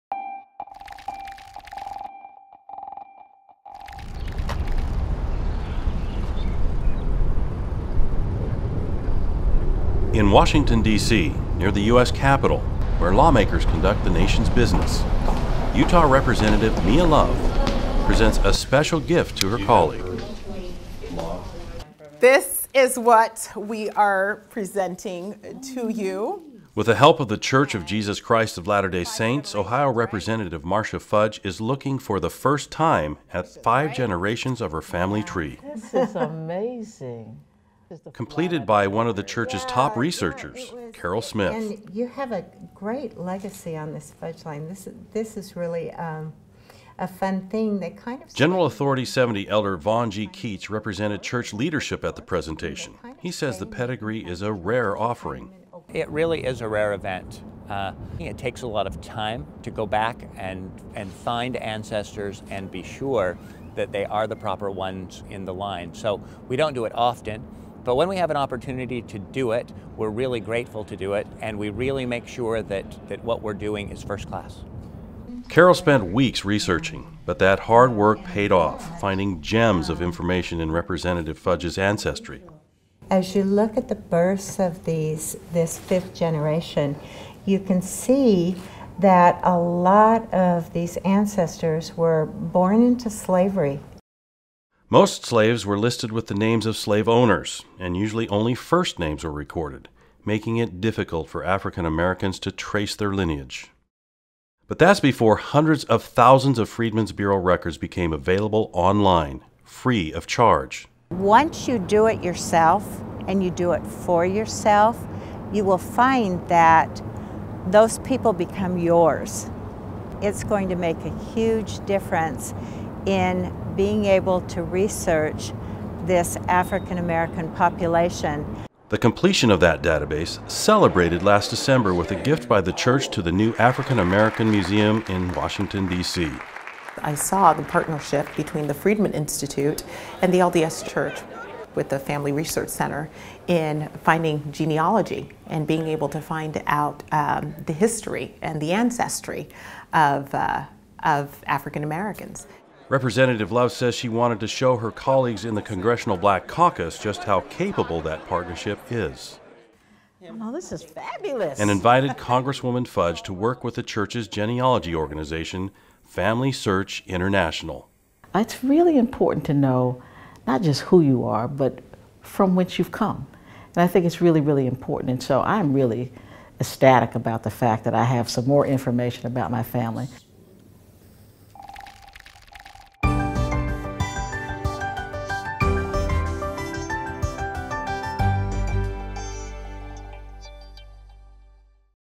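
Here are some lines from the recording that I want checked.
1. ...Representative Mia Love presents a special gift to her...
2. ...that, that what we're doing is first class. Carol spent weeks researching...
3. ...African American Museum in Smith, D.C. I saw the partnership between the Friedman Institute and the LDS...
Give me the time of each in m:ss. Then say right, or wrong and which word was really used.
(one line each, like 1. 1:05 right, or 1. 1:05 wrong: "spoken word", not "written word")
1. 0:16 right
2. 1:12 right
3. 2:13 wrong: "Washington", not "Smith".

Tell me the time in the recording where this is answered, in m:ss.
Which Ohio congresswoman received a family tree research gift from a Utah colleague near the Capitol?
0:30.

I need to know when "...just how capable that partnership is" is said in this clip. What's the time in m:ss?
2:36.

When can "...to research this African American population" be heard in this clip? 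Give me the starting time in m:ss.
2:04.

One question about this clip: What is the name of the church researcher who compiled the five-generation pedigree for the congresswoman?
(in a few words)
Carol Smith.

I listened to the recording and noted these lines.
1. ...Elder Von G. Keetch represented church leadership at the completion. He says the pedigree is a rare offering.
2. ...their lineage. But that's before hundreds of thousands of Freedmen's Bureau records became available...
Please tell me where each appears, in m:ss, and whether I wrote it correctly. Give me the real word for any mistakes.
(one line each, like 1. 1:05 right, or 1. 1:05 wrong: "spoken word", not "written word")
1. 0:49 wrong: "presentation", not "completion"
2. 1:42 right.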